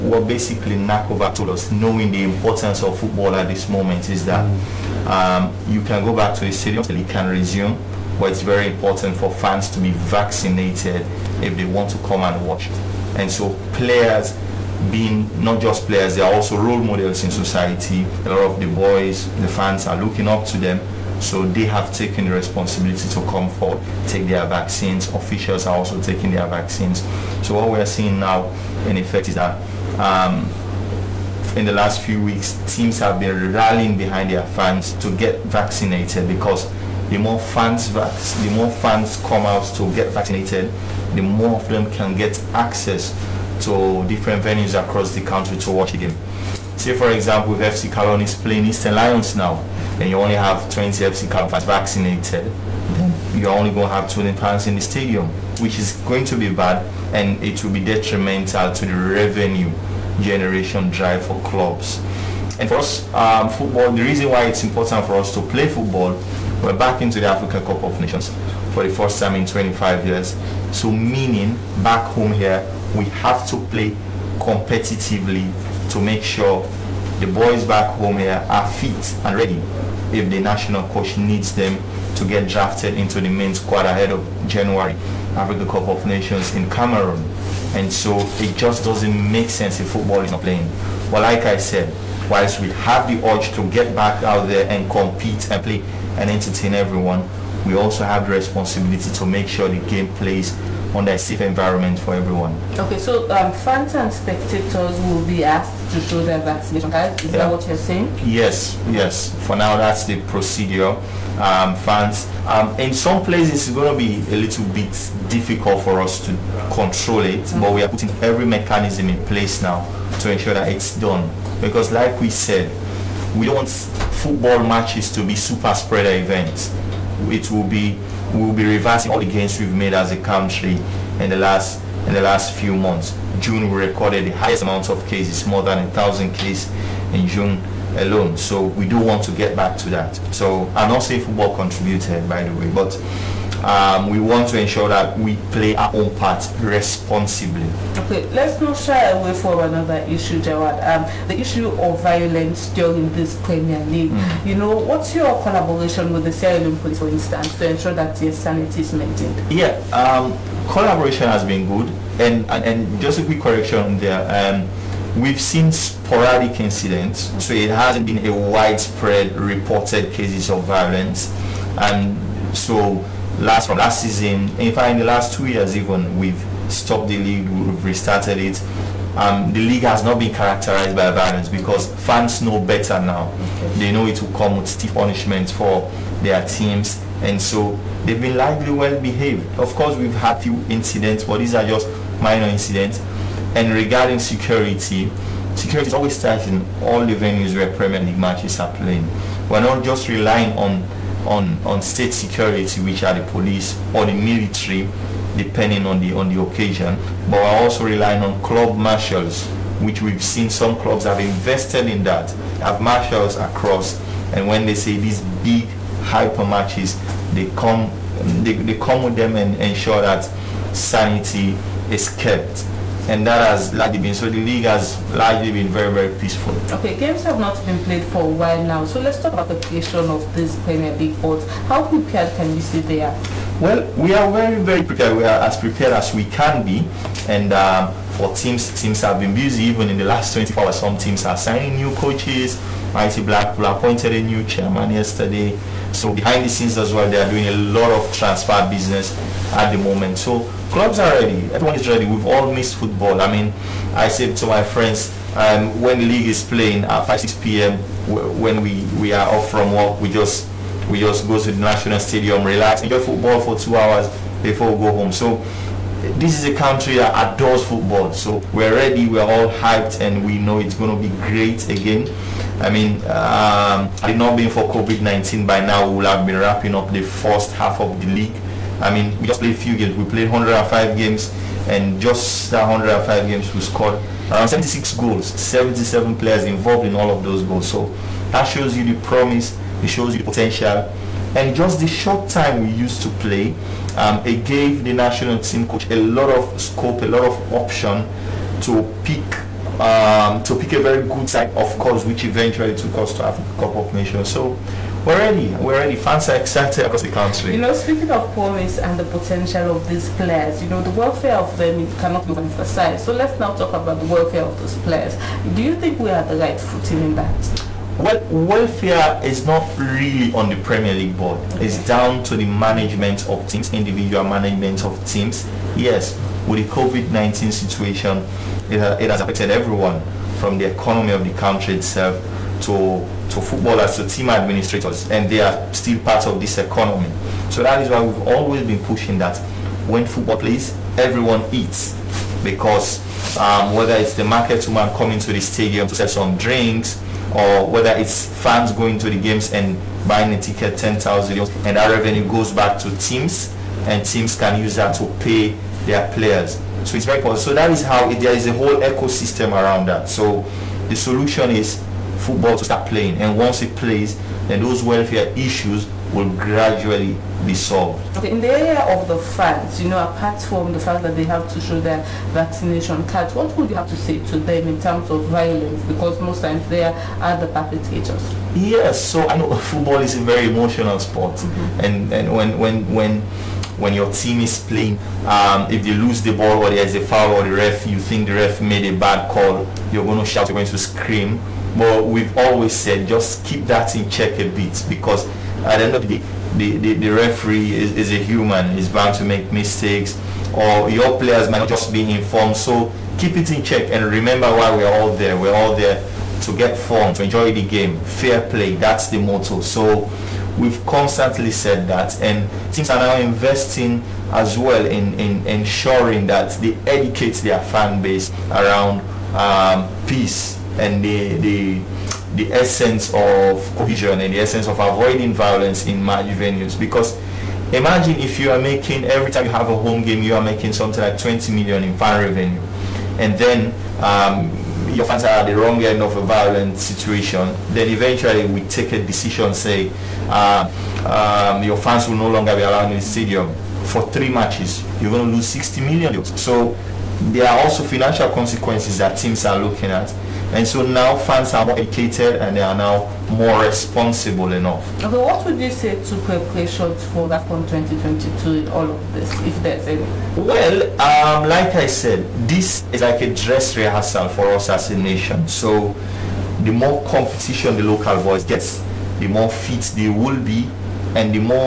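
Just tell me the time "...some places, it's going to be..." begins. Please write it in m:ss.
1:52.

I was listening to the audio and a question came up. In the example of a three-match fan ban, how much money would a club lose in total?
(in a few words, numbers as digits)
60 million.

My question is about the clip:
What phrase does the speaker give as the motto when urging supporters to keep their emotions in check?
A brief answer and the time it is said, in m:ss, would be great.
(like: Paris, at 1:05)
Fair play, at 6:48.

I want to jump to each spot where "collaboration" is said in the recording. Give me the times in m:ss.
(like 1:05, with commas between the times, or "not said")
2:35, 2:40.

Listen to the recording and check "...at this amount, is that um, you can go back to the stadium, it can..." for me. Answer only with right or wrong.
wrong.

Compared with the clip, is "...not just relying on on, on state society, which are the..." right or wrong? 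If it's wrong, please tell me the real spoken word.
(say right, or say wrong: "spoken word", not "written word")
wrong: "security", not "society".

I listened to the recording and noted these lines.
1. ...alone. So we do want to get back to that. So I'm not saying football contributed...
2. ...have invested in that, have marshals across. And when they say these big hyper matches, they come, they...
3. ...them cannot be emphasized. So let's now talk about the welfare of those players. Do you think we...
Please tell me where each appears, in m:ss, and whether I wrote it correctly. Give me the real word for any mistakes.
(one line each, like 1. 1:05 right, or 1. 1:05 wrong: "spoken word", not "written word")
1. 2:17 right
2. 3:31 right
3. 5:11 right.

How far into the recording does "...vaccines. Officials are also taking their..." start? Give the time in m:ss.
0:24.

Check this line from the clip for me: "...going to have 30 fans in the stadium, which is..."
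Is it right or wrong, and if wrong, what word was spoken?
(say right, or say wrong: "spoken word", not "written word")
wrong: "20", not "30".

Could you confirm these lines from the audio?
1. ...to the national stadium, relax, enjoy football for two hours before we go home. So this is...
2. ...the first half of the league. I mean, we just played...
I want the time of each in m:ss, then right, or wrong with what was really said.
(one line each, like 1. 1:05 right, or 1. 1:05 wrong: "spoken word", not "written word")
1. 4:21 right
2. 4:36 right.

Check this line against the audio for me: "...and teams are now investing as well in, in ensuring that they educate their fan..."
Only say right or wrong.
right.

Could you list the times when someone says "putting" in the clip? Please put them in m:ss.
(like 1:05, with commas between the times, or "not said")
1:57.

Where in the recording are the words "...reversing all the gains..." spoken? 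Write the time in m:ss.
2:08.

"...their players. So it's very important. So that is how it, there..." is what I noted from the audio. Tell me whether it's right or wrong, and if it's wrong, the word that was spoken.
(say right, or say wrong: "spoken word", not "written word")
right.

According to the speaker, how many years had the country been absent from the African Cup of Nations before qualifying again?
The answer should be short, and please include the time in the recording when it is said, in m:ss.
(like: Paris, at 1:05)
25, at 1:09.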